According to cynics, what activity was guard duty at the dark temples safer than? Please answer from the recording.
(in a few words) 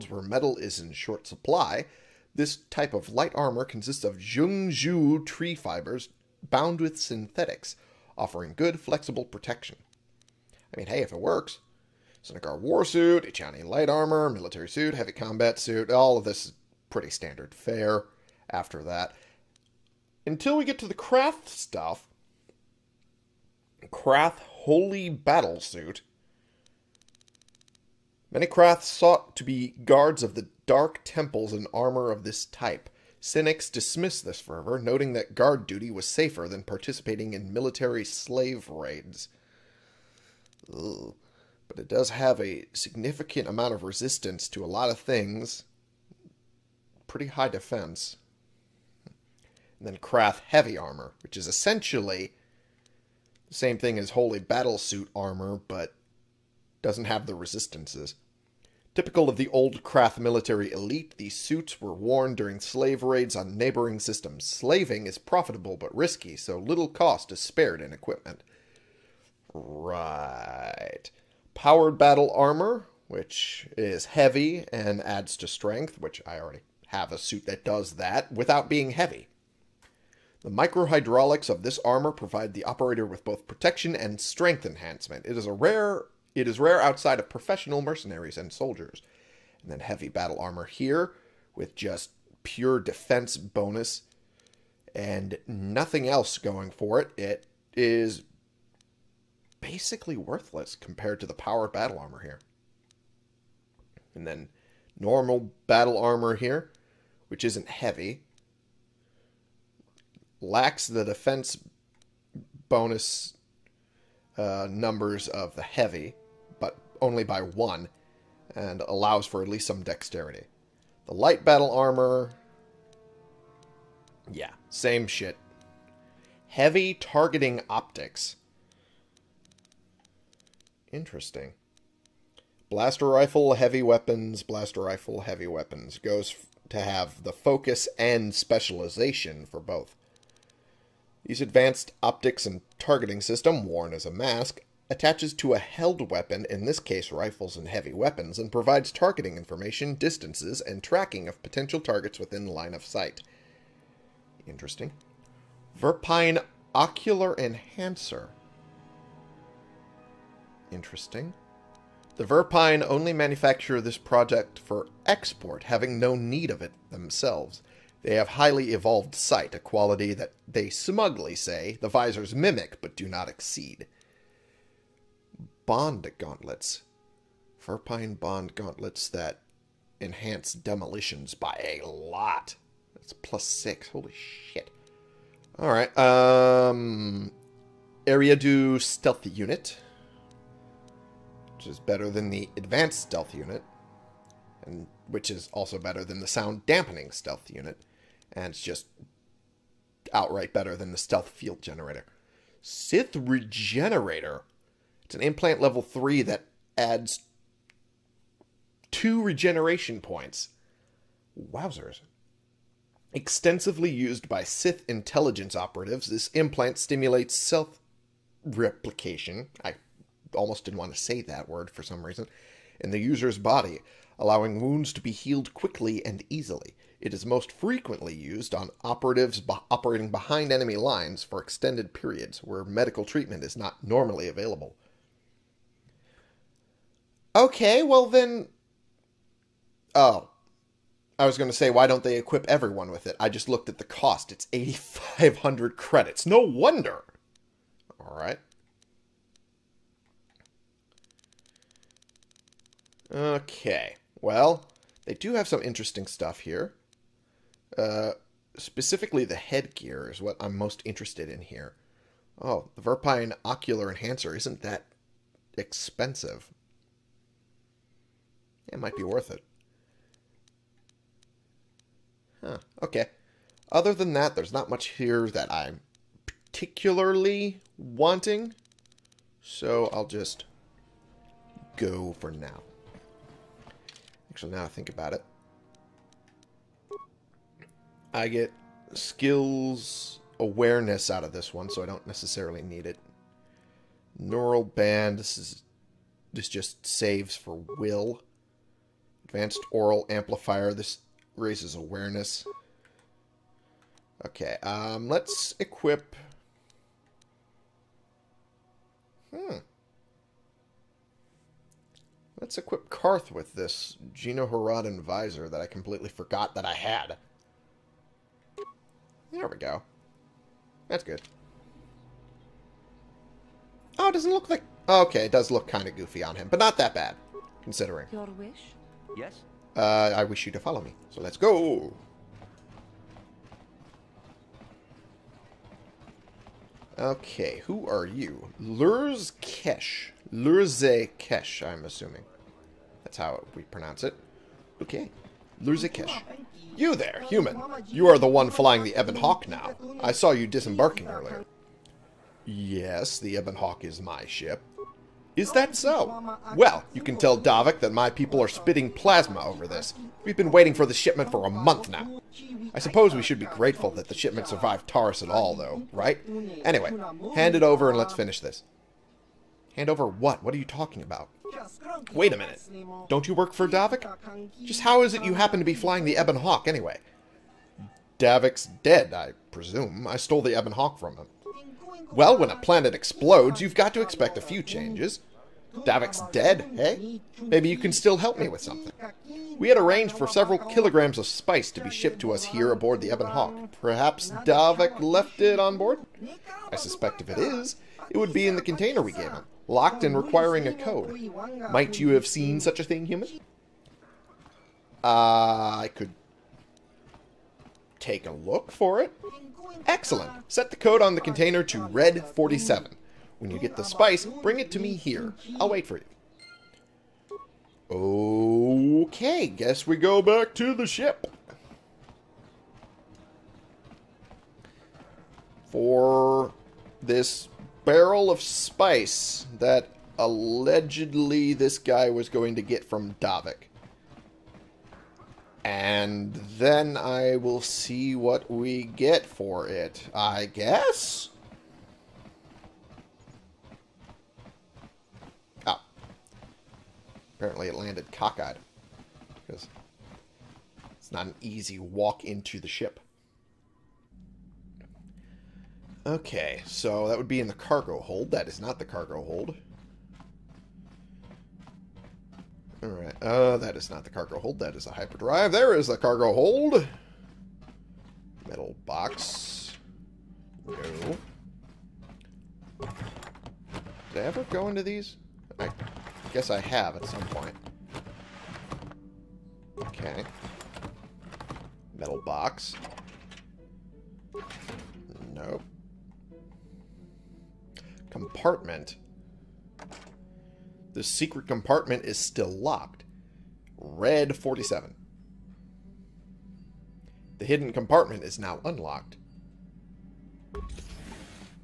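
military slave raids.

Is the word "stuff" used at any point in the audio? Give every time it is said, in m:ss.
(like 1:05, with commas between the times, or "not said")
0:21, 4:16.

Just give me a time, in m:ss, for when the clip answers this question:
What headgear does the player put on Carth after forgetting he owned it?
5:14.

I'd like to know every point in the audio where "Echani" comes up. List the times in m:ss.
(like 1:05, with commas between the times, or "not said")
0:13.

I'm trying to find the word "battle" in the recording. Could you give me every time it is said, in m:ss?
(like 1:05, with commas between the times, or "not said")
0:25, 0:54, 1:11, 1:30, 1:41, 1:45, 2:01.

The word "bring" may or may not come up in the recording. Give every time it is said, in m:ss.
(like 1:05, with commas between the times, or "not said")
6:54.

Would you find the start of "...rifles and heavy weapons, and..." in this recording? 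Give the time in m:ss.
2:27.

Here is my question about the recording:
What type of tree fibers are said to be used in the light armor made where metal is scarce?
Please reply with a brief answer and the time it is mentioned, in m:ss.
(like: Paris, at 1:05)
Zhengzhu, at 0:04.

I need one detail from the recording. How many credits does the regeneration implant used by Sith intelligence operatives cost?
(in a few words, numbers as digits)
8,500 credits.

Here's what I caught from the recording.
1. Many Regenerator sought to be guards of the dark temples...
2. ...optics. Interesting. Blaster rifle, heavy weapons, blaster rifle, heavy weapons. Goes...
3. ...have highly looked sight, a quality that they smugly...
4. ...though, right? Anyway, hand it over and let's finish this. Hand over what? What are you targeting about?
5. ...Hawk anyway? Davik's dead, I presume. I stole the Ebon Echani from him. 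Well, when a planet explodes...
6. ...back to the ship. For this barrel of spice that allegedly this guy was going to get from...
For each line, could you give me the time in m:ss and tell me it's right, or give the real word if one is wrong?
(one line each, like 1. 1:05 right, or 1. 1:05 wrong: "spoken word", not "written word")
1. 0:28 wrong: "Krath", not "Regenerator"
2. 2:07 right
3. 2:48 wrong: "evolved", not "looked"
4. 6:05 wrong: "talking", not "targeting"
5. 6:16 wrong: "Hawk", not "Echani"
6. 7:00 right.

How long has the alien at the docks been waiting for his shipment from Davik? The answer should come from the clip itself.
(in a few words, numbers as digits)
a month.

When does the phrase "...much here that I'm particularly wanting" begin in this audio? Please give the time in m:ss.
4:34.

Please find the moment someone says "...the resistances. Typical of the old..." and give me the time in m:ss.
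0:57.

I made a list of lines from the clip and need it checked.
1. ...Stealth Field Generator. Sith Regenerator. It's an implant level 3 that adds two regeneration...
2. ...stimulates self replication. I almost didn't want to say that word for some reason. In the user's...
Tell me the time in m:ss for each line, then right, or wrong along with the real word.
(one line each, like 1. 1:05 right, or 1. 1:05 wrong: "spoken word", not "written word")
1. 3:20 right
2. 3:36 right.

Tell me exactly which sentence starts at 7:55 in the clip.
I guess I have at some point.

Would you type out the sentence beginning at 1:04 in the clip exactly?
Slaving is profitable but risky, so little cost is spared in equipment.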